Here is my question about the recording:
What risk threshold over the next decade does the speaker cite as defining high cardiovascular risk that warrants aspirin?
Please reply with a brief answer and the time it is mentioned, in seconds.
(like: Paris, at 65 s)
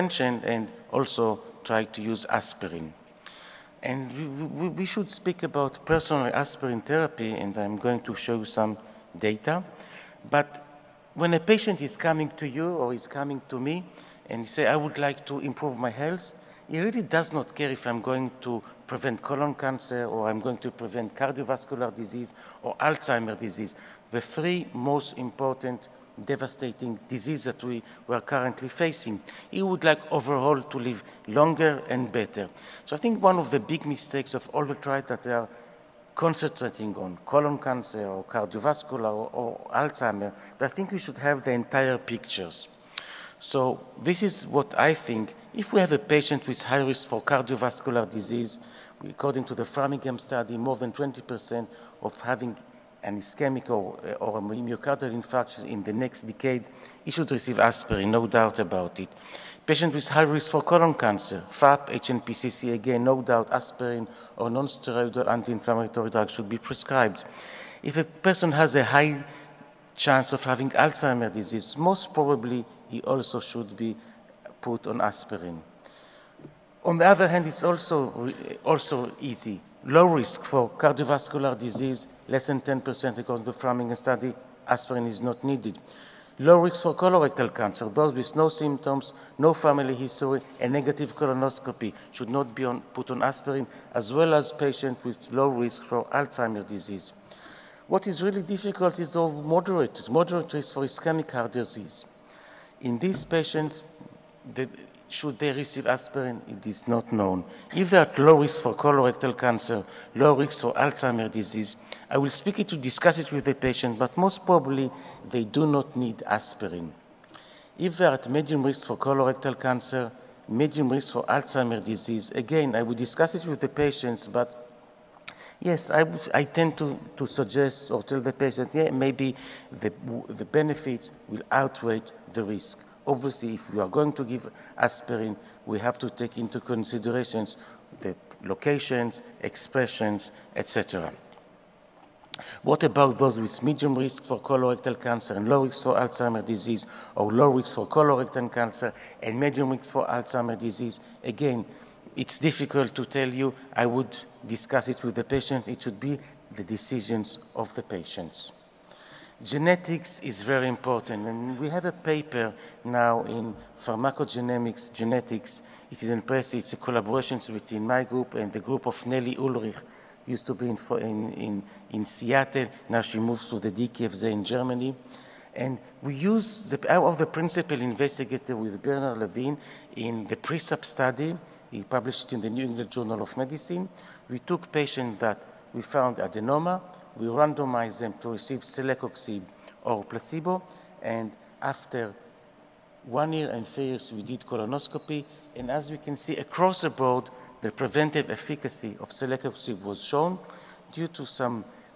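more than 20%, at 50 s.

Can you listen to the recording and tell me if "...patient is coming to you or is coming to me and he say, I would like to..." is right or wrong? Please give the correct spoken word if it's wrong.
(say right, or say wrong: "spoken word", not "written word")
right.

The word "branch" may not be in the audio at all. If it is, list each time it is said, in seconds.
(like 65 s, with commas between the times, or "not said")
not said.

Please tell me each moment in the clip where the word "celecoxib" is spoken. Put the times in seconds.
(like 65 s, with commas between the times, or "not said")
188 s, 199 s.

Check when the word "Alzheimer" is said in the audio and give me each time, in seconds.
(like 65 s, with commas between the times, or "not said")
22 s, 39 s, 70 s, 96 s, 110 s, 121 s, 145 s, 150 s.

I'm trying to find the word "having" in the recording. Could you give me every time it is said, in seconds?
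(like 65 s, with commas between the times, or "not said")
52 s, 70 s.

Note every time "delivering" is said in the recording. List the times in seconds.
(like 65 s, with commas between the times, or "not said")
not said.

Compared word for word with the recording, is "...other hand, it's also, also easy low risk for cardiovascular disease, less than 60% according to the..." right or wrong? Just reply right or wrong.
wrong.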